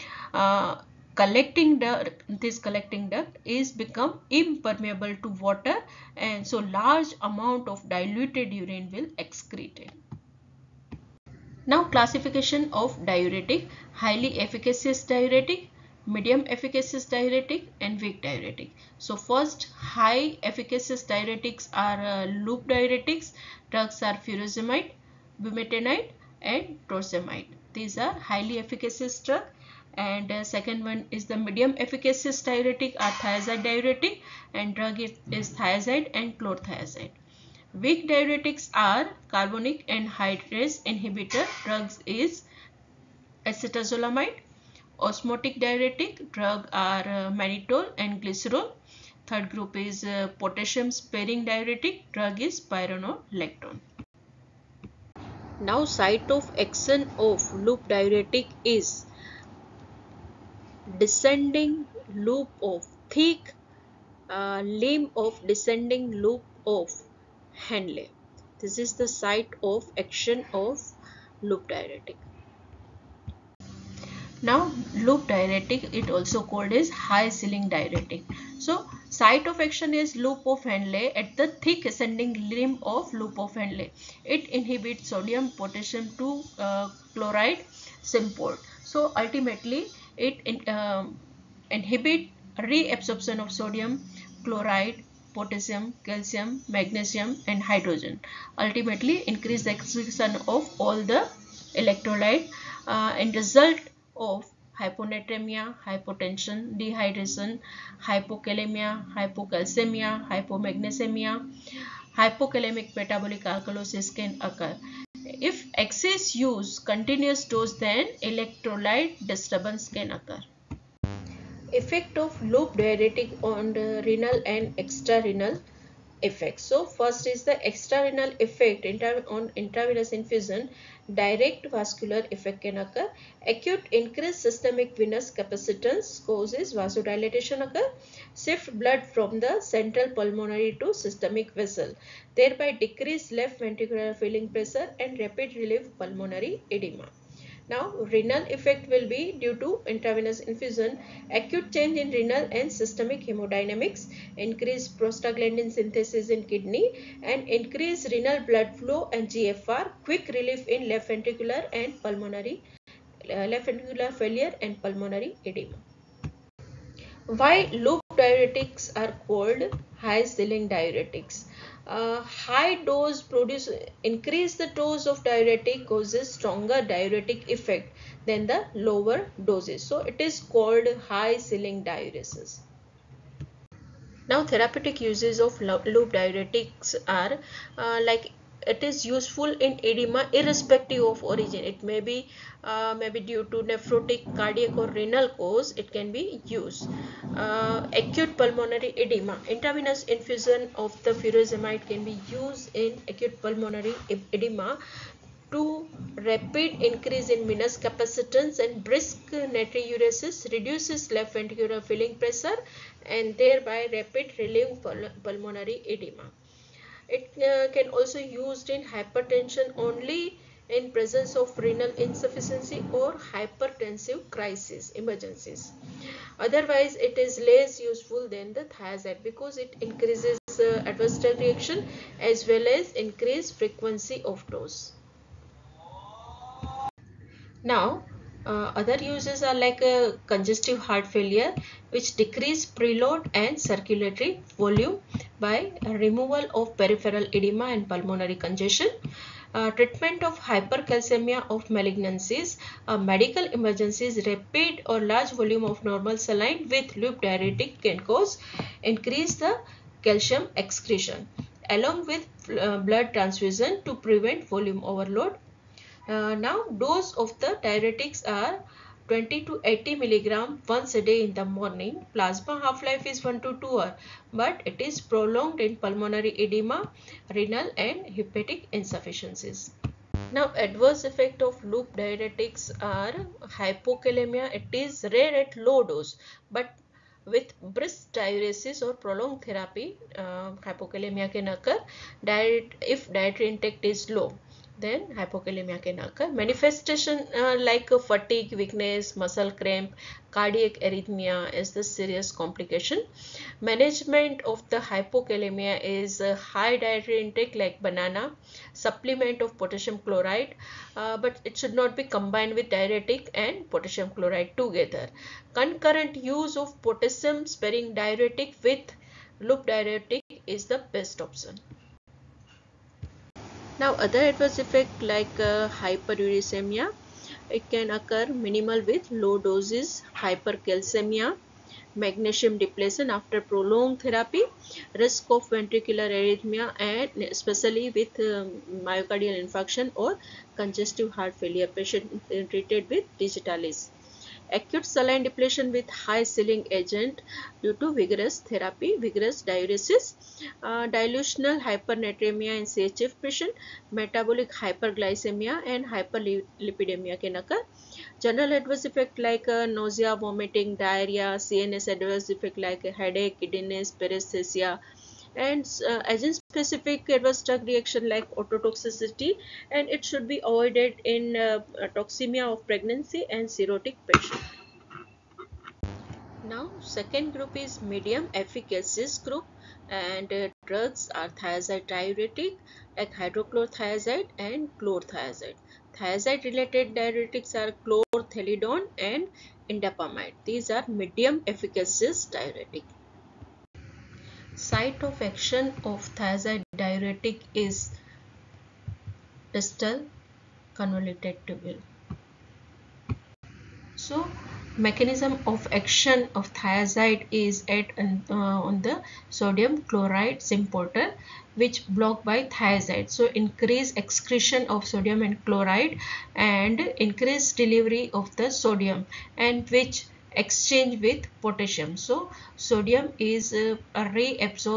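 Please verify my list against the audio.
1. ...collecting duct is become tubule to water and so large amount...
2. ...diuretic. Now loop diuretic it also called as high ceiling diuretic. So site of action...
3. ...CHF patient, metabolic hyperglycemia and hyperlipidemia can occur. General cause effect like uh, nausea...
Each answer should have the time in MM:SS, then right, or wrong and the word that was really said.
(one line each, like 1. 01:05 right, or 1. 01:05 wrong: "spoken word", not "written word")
1. 00:02 wrong: "impermeable", not "tubule"
2. 01:11 right
3. 05:52 wrong: "adverse", not "cause".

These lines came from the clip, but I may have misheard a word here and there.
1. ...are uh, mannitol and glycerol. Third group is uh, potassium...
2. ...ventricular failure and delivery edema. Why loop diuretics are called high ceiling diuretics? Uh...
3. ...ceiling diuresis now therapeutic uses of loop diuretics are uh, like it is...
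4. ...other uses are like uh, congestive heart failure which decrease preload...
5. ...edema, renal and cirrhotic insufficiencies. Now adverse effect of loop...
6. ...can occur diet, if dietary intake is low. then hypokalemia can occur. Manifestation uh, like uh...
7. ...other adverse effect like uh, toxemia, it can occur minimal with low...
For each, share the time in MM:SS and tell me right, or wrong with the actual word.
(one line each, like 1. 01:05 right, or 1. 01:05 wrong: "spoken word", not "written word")
1. 00:46 right
2. 02:43 wrong: "pulmonary", not "delivery"
3. 03:01 right
4. 03:58 right
5. 04:36 wrong: "hepatic", not "cirrhotic"
6. 04:51 right
7. 05:23 wrong: "hyperuricemia", not "toxemia".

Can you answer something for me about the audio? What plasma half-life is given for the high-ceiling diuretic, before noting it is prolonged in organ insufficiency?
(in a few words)
1 to 2 hours.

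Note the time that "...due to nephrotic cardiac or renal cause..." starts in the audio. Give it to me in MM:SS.
03:13.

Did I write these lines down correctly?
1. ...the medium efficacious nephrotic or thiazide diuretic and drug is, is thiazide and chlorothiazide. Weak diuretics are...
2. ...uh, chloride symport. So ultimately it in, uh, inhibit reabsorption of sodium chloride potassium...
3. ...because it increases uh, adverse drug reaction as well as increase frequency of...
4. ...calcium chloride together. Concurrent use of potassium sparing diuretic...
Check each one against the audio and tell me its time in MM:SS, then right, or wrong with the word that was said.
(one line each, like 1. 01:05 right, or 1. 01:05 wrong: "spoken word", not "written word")
1. 00:31 wrong: "diuretic", not "nephrotic"
2. 01:26 right
3. 03:49 right
4. 05:13 wrong: "potassium", not "calcium".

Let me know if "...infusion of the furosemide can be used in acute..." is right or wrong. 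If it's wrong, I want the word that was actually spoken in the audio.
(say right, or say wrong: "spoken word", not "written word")
right.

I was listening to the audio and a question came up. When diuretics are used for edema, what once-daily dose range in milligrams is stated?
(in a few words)
20 to 80 milligrams.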